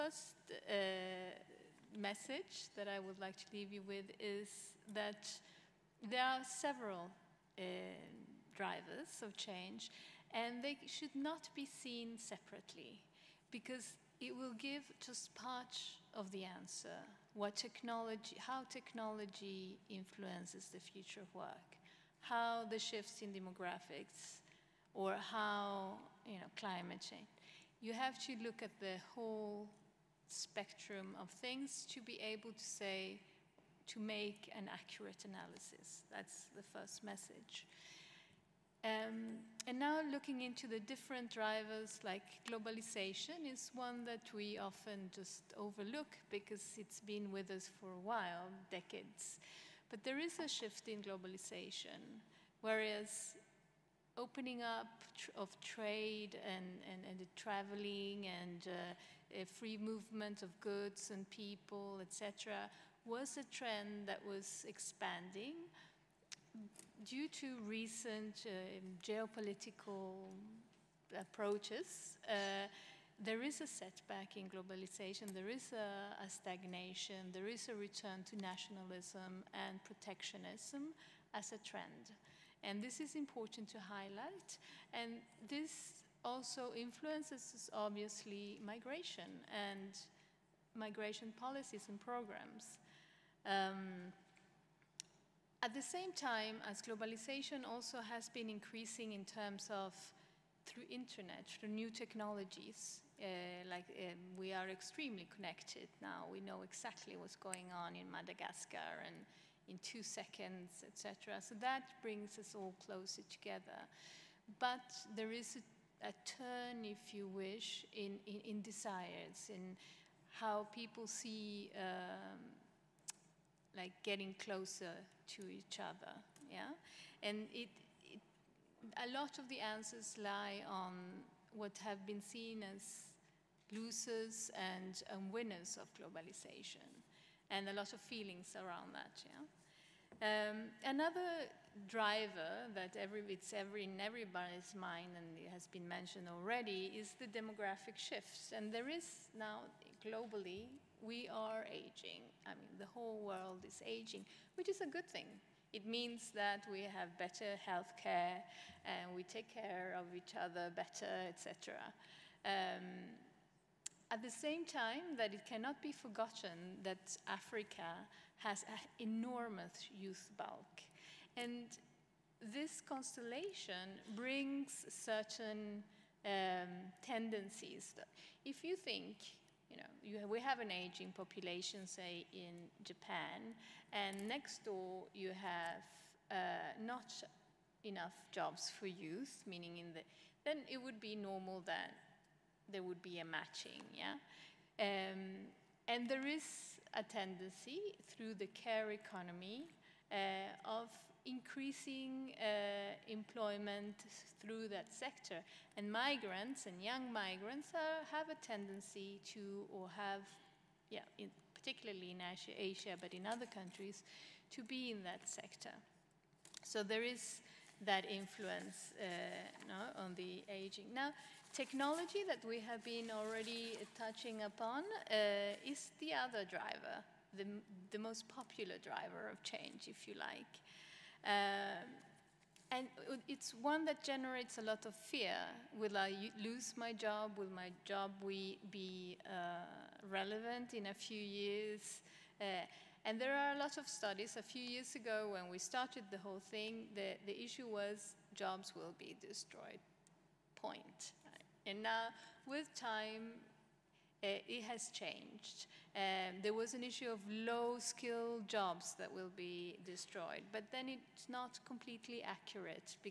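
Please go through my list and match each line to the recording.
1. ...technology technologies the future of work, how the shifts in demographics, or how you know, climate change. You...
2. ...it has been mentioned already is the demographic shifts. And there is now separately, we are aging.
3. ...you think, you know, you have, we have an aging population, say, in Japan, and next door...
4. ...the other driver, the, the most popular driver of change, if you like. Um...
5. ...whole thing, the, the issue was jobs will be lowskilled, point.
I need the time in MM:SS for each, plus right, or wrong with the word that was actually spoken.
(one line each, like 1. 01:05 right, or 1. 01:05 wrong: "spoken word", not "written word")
1. 00:18 wrong: "influences", not "technologies"
2. 02:25 wrong: "globally", not "separately"
3. 02:58 right
4. 03:45 right
5. 04:06 wrong: "destroyed", not "lowskilled".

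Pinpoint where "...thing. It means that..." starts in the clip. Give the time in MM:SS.
02:35.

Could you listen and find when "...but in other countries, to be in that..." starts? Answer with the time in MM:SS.
03:32.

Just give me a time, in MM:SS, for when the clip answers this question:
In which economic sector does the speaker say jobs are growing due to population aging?
03:18.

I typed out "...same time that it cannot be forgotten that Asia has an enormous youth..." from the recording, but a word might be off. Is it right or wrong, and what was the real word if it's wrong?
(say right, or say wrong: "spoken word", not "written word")
wrong: "Africa", not "Asia".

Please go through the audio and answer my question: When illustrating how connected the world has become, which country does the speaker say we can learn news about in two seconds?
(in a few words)
Madagascar.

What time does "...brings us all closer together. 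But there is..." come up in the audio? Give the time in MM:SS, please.
01:52.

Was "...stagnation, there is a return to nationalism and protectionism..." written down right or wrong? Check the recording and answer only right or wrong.
right.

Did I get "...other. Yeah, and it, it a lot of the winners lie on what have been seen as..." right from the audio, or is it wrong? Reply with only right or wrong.
wrong.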